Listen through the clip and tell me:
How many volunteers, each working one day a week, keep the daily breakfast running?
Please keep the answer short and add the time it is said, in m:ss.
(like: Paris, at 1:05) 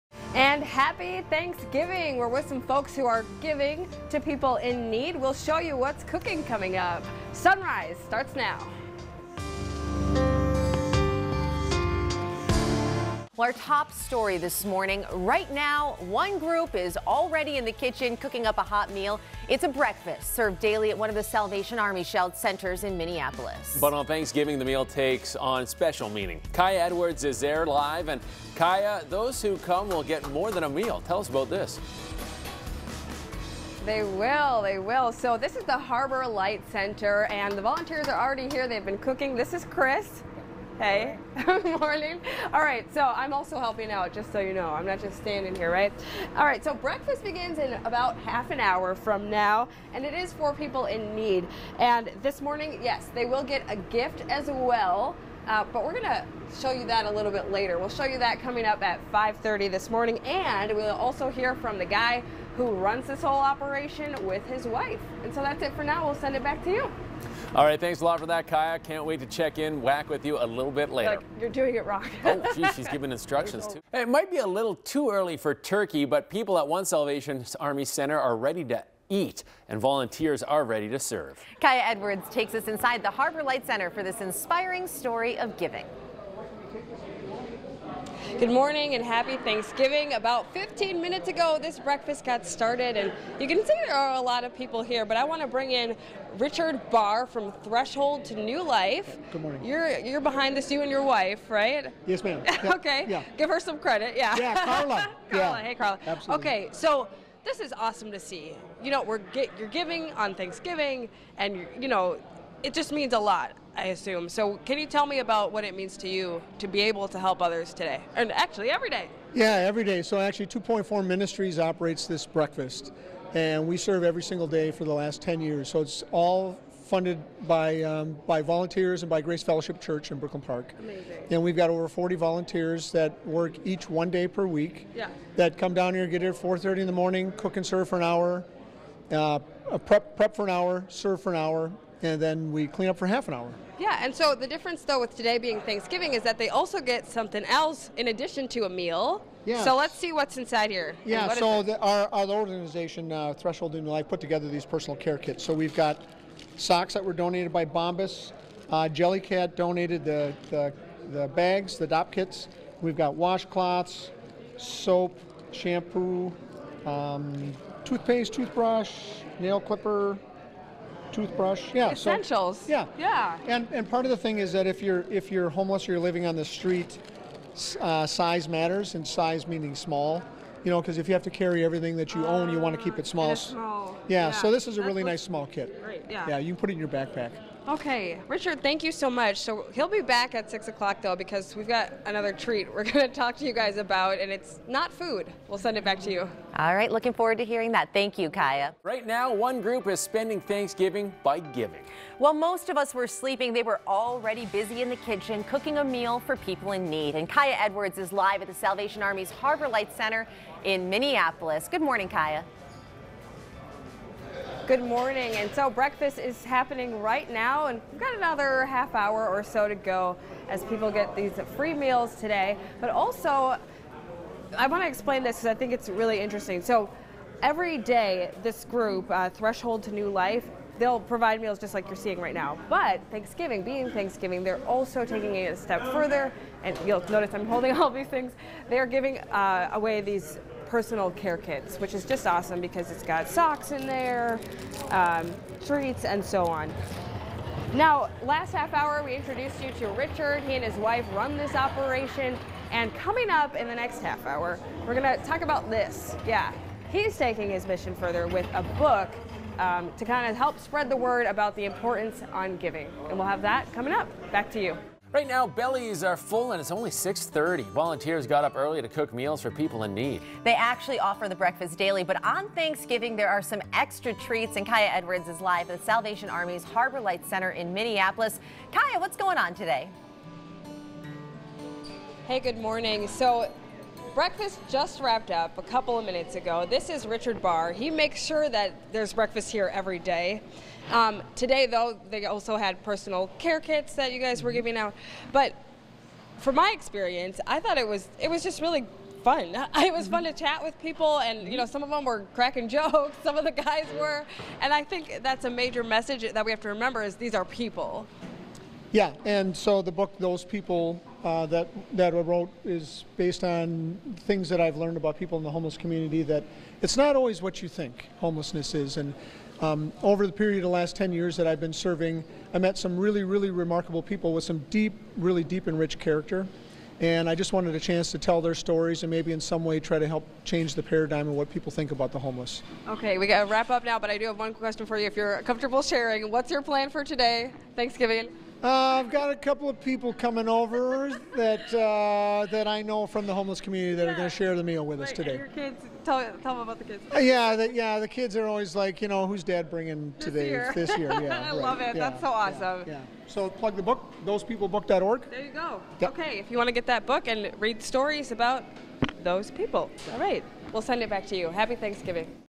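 over 40, at 2:11.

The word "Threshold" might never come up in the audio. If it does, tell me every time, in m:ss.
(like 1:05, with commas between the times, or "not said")
1:37, 2:33, 3:49.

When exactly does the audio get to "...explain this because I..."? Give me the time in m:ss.
3:44.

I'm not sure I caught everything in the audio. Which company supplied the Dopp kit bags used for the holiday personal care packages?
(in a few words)
Jellycat.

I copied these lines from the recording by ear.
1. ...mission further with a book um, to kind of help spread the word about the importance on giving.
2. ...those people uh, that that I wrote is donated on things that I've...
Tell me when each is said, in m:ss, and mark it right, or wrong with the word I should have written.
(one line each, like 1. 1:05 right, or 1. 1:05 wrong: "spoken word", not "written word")
1. 4:17 right
2. 5:10 wrong: "based", not "donated".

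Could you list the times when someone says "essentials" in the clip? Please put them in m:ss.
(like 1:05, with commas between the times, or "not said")
2:51.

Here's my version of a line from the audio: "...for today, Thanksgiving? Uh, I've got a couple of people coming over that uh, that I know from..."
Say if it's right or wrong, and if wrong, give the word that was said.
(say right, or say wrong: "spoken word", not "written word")
right.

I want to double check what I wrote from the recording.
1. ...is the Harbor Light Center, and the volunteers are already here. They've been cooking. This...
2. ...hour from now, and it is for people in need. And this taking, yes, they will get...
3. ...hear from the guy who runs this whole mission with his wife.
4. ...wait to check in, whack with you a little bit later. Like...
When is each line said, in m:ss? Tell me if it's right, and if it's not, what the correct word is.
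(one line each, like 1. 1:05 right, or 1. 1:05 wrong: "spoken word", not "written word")
1. 0:35 right
2. 0:48 wrong: "morning", not "taking"
3. 1:01 wrong: "operation", not "mission"
4. 1:09 right.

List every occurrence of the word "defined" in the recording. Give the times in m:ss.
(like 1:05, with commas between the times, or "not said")
not said.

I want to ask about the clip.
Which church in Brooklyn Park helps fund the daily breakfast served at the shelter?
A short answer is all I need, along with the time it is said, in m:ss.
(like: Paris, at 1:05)
Grace Fellowship Church, at 2:09.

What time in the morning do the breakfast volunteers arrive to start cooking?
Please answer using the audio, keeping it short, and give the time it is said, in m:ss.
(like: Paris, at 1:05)
4:30, at 2:16.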